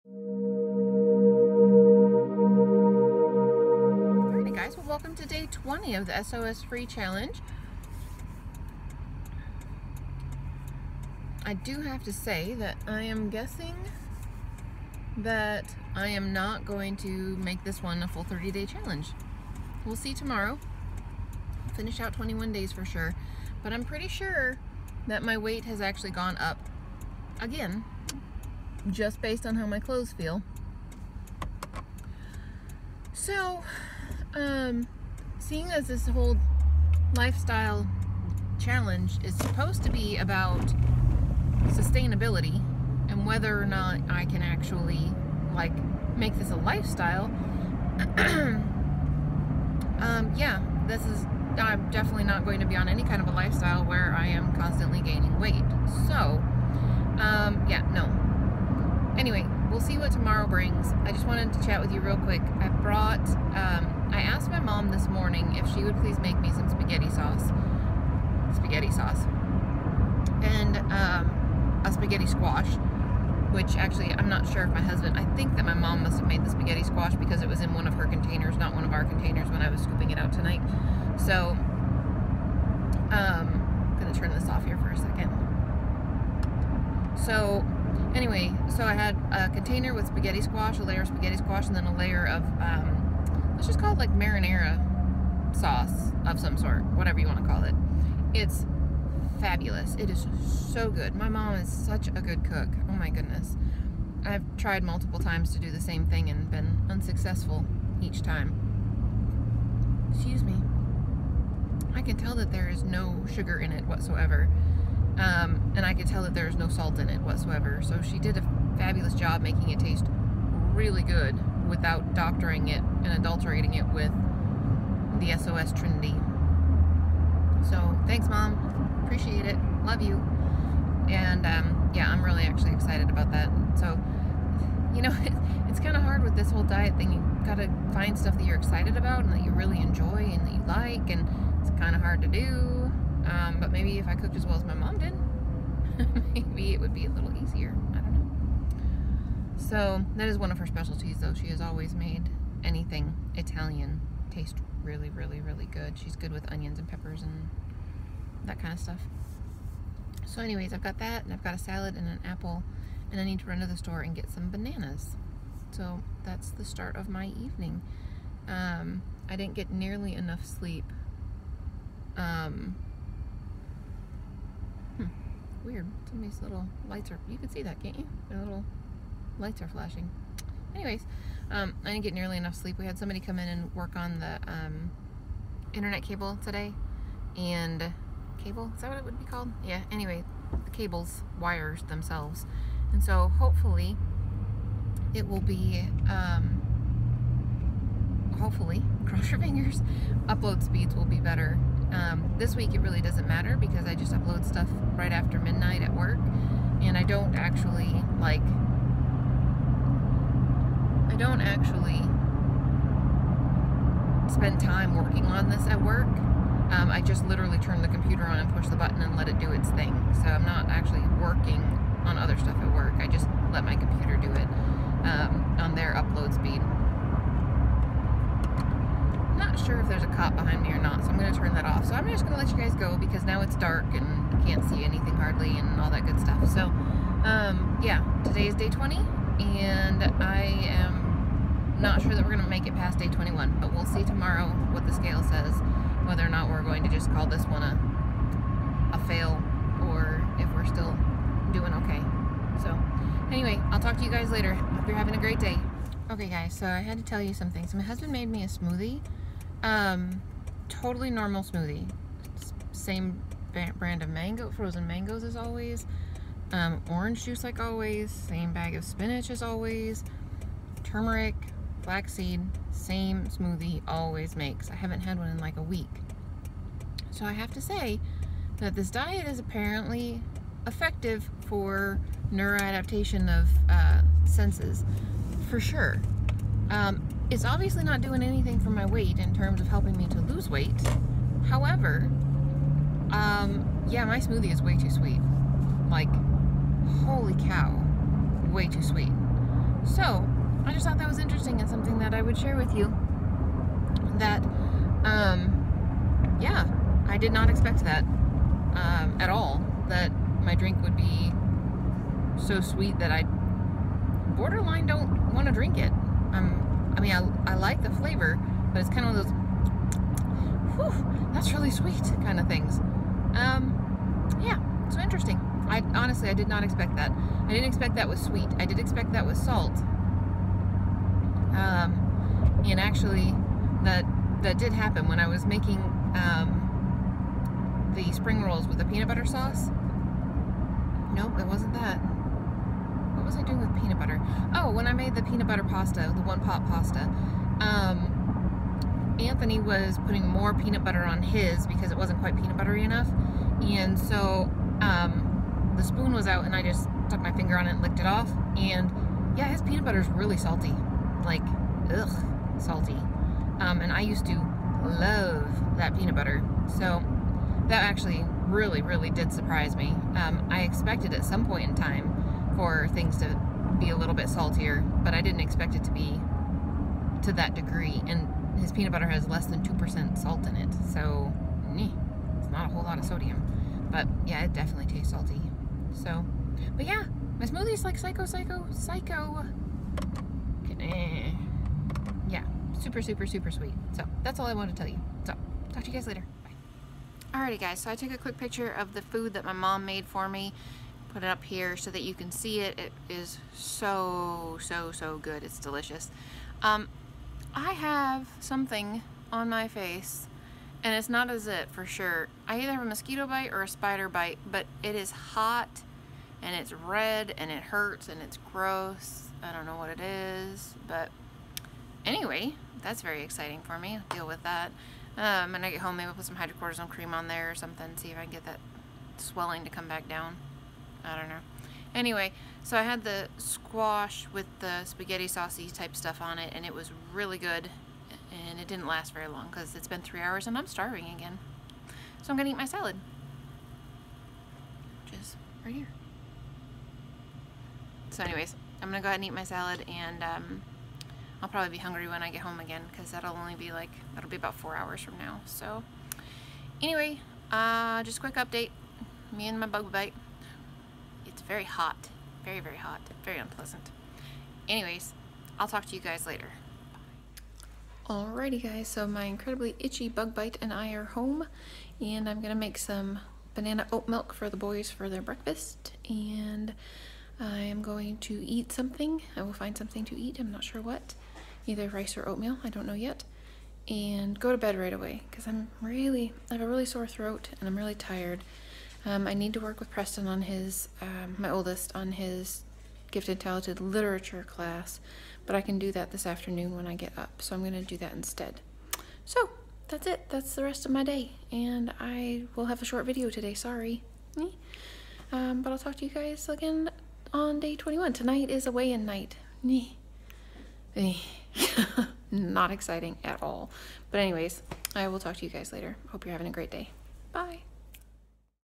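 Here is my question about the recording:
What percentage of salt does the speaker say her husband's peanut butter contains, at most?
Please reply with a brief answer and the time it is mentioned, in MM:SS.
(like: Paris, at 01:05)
Less than 2%, at 06:19.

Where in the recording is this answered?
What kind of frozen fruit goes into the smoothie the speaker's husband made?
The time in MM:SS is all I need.
04:24.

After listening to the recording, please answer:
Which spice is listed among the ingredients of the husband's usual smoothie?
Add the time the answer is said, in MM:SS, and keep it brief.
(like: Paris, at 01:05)
Turmeric, at 04:30.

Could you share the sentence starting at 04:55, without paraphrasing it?
Like, holy cow, way too sweet.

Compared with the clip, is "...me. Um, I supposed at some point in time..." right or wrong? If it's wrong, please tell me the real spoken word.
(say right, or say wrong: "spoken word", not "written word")
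wrong: "expected", not "supposed".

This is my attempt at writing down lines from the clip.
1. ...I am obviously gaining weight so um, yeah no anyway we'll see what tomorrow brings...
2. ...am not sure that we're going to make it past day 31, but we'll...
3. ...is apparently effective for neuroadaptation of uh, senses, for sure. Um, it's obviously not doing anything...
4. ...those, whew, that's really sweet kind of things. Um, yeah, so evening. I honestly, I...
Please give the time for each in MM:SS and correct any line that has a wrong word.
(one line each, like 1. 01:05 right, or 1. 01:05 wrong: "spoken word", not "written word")
1. 00:54 wrong: "constantly", not "obviously"
2. 04:00 wrong: "21", not "31"
3. 04:39 right
4. 05:19 wrong: "interesting", not "evening".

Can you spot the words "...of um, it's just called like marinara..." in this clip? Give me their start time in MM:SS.
01:32.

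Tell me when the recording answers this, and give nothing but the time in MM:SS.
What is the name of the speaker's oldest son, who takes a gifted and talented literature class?
08:09.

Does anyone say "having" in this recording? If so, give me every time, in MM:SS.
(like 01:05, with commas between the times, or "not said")
04:14, 08:36.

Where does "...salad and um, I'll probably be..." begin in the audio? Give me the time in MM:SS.
07:29.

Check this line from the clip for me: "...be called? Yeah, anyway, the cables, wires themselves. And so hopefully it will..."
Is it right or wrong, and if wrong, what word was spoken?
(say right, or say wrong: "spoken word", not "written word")
right.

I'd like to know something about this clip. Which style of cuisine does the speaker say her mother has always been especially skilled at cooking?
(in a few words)
Italian.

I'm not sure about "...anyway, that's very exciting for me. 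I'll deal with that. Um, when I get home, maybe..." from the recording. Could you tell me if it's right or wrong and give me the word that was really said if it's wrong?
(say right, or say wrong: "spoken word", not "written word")
right.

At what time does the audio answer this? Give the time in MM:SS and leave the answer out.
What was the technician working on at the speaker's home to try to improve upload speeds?
03:05.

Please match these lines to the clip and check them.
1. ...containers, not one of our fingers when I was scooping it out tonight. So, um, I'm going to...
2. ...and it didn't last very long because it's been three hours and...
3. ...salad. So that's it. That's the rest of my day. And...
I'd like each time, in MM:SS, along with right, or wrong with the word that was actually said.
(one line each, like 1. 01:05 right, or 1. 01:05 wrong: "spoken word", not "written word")
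1. 01:18 wrong: "containers", not "fingers"
2. 07:18 right
3. 08:18 wrong: "instead", not "salad".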